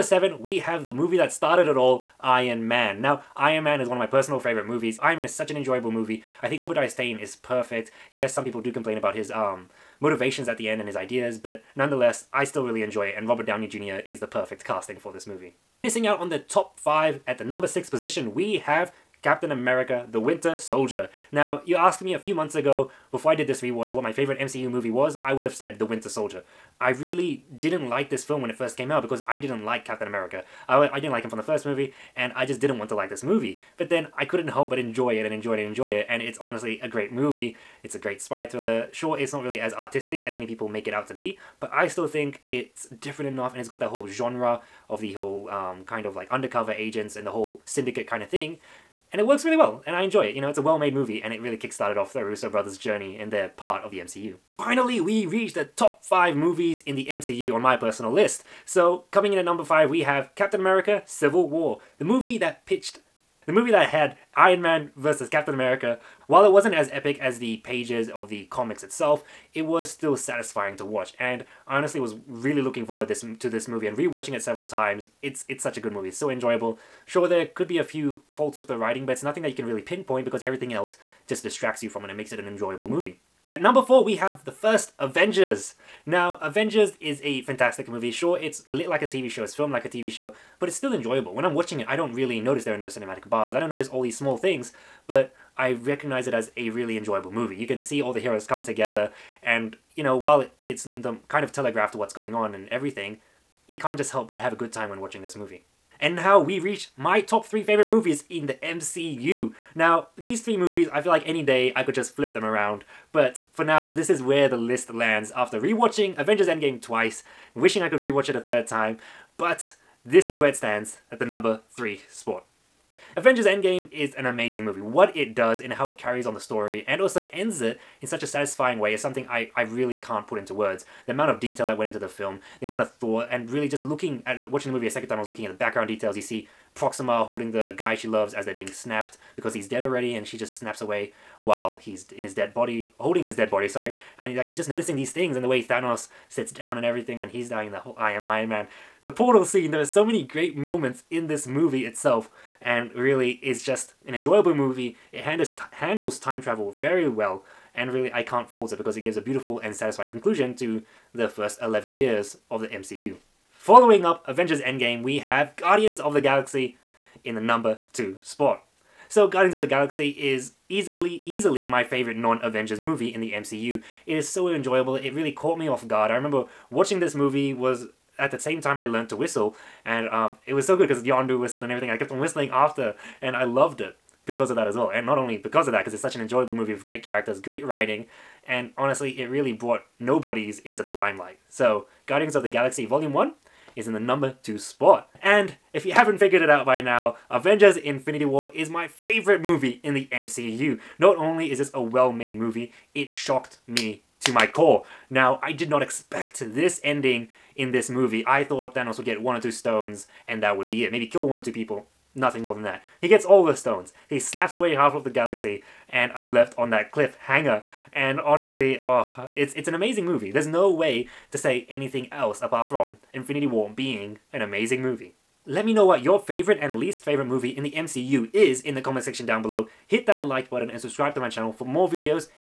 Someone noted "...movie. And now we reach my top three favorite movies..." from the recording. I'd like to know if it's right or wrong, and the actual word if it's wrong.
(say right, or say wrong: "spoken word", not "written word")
right.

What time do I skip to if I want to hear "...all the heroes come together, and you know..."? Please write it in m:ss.
1:38.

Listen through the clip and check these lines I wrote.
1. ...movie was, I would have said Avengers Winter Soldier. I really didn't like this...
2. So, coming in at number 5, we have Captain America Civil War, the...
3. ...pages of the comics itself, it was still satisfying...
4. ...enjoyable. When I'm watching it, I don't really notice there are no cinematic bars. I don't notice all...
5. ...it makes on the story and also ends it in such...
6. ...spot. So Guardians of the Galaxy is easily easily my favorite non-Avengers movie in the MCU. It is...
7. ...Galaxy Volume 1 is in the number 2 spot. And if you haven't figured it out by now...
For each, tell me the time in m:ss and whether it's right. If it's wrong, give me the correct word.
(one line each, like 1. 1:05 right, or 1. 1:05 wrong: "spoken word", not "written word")
1. 0:24 wrong: "The", not "Avengers"
2. 0:58 right
3. 1:07 right
4. 1:30 right
5. 2:05 wrong: "carries", not "makes"
6. 2:48 right
7. 3:12 right.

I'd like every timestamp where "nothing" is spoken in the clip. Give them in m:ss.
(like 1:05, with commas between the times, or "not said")
1:19, 3:32.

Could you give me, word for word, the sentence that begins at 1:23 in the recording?
At number 4 we have the first Avengers.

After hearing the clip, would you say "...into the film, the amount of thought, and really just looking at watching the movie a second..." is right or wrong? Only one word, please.
right.